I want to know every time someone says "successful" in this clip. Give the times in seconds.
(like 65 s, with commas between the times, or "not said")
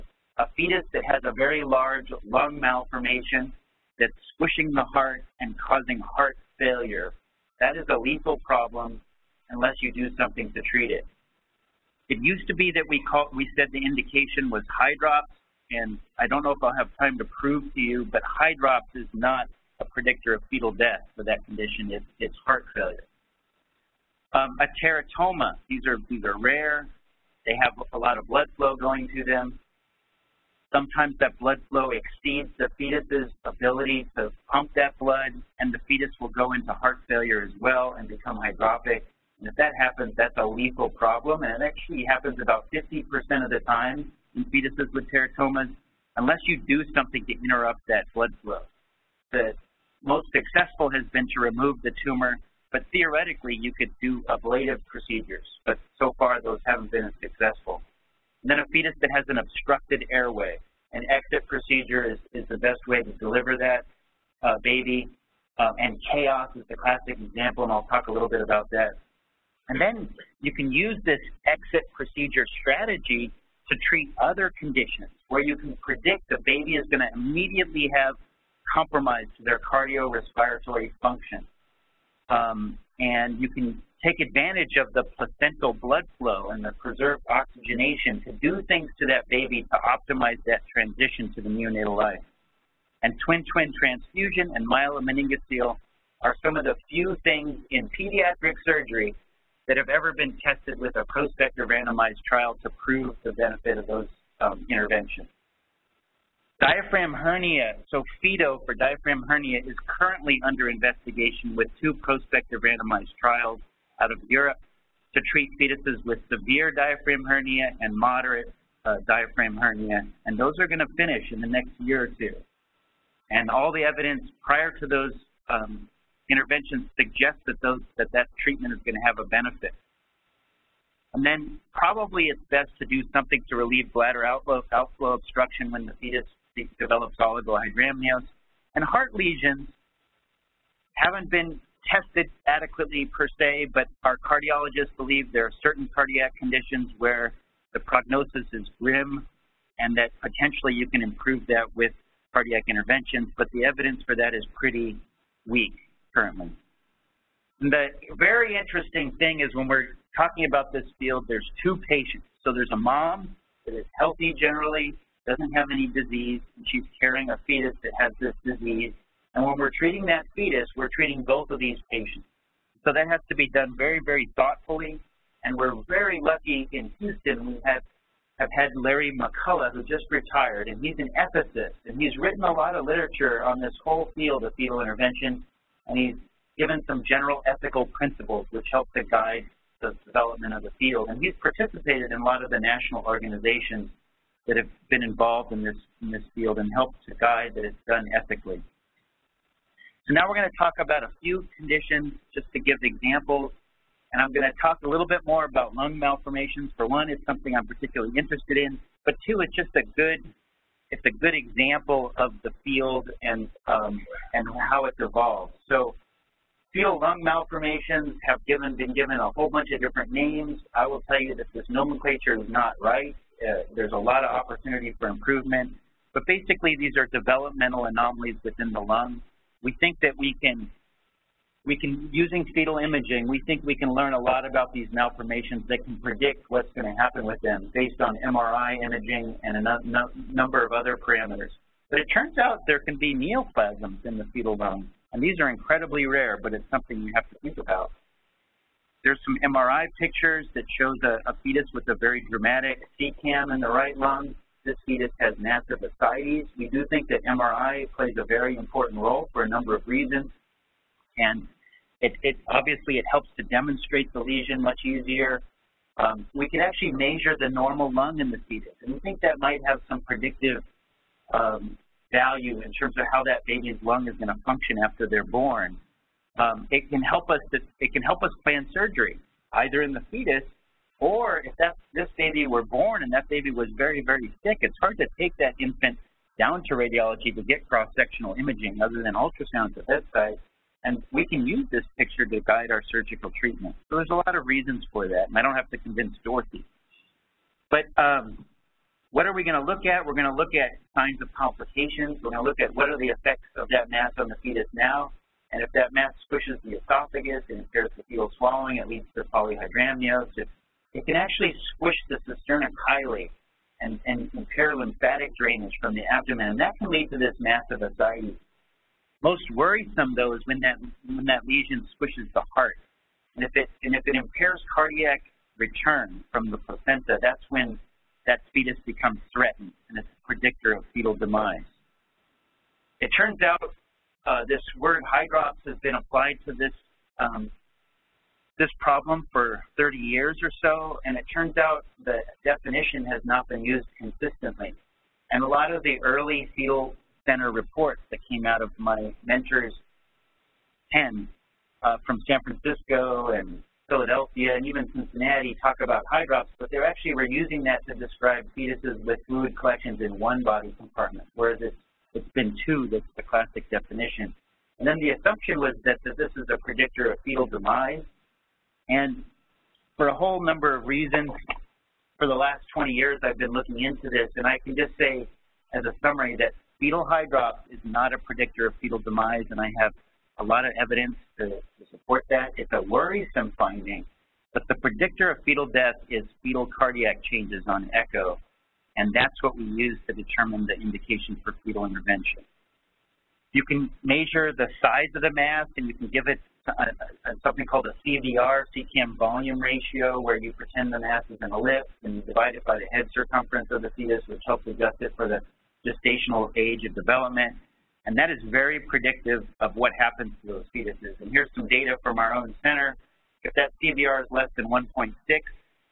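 50 s, 57 s.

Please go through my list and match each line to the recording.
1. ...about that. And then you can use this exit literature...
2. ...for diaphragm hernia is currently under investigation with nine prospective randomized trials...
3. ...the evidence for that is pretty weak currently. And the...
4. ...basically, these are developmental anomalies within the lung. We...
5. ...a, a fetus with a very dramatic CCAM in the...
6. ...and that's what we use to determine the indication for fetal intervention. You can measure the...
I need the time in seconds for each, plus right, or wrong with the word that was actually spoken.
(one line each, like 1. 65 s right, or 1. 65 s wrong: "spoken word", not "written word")
1. 68 s wrong: "procedure", not "literature"
2. 108 s wrong: "two", not "nine"
3. 153 s right
4. 226 s right
5. 251 s right
6. 388 s right.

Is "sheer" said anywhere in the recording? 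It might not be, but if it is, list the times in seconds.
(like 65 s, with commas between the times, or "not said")
not said.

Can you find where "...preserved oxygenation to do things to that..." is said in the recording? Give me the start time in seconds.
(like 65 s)
86 s.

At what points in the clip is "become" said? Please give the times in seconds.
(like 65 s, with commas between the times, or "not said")
38 s, 328 s.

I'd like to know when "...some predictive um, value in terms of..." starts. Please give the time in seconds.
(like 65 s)
269 s.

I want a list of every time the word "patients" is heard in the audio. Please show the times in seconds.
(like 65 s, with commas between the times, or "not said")
161 s, 171 s.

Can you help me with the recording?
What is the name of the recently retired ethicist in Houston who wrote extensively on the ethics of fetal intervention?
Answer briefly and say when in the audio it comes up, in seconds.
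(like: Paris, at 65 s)
Larry McCullough, at 178 s.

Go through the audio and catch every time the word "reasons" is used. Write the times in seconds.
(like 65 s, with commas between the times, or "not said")
259 s, 294 s, 370 s.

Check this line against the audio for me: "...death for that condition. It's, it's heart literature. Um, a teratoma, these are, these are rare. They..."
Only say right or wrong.
wrong.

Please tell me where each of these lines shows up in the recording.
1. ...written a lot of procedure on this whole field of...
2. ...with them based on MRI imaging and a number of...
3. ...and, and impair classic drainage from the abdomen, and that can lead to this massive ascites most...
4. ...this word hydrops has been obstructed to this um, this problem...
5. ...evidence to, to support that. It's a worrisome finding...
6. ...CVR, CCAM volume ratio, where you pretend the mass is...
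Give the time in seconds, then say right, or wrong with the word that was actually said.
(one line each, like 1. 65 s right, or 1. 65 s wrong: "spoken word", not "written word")
1. 182 s wrong: "literature", not "procedure"
2. 237 s right
3. 313 s wrong: "lymphatic", not "classic"
4. 334 s wrong: "applied", not "obstructed"
5. 380 s right
6. 398 s right.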